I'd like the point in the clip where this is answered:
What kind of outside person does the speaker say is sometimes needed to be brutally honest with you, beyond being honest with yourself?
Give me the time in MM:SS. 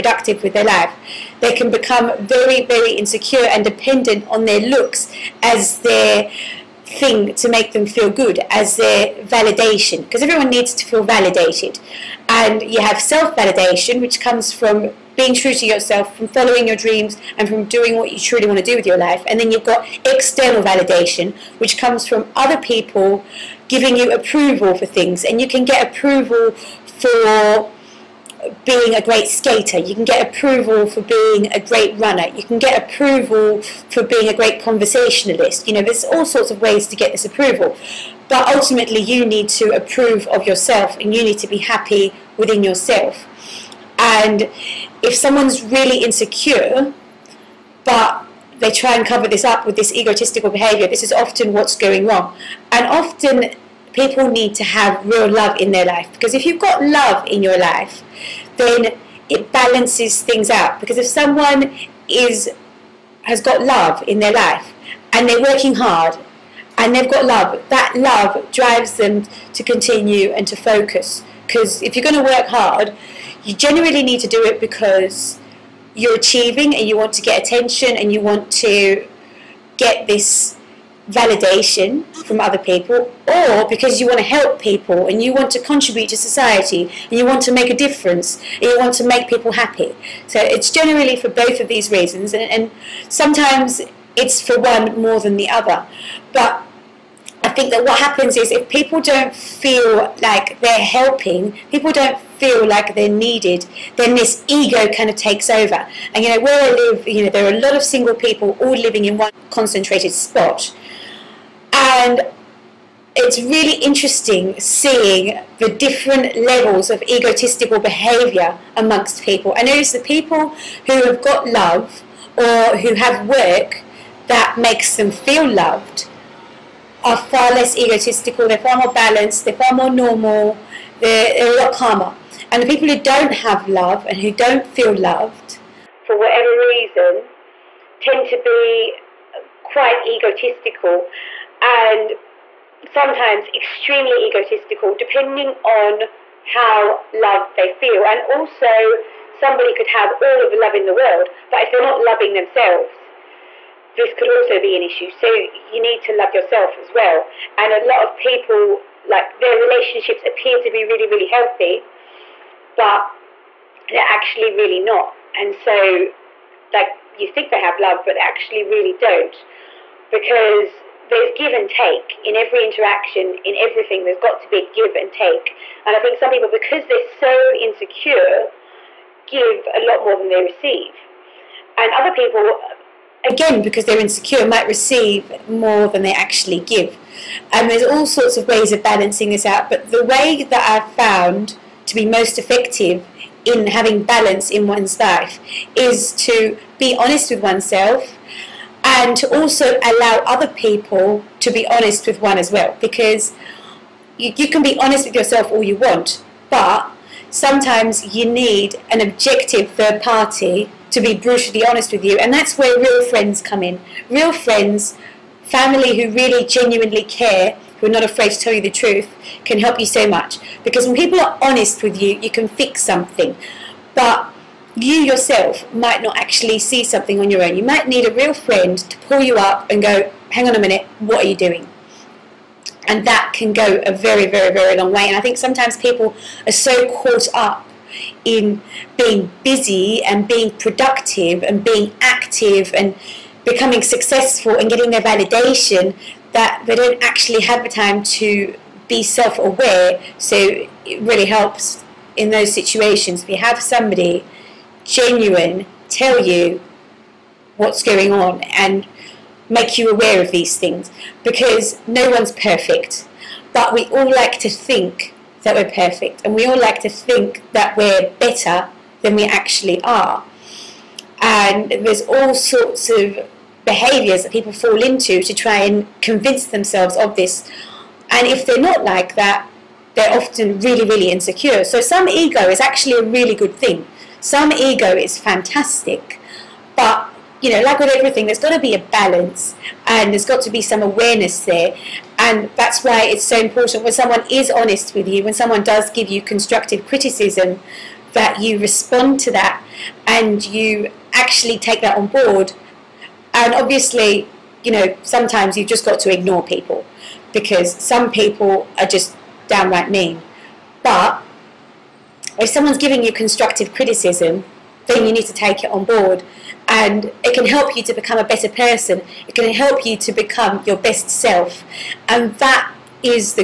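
03:28.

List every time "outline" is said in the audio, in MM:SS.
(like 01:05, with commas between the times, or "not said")
not said.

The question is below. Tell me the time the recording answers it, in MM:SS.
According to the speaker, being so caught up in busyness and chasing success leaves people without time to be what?
04:09.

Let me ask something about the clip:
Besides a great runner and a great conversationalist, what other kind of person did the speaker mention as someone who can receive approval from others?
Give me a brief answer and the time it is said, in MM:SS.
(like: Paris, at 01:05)
great skater, at 00:29.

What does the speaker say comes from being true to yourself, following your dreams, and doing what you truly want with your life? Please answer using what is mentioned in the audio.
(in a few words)
self validation.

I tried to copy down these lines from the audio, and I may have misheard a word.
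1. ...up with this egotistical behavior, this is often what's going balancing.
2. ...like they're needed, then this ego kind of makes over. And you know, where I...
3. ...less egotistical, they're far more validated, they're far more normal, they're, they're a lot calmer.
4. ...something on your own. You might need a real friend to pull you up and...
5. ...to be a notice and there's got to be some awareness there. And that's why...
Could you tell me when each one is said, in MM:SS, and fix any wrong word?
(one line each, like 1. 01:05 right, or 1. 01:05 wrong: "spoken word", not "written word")
1. 00:49 wrong: "wrong", not "balancing"
2. 01:42 wrong: "takes", not "makes"
3. 02:07 wrong: "balanced", not "validated"
4. 03:46 right
5. 04:48 wrong: "balance", not "notice".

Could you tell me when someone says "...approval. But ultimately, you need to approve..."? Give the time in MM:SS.
00:37.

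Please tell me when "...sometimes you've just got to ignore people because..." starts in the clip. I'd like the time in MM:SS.
05:05.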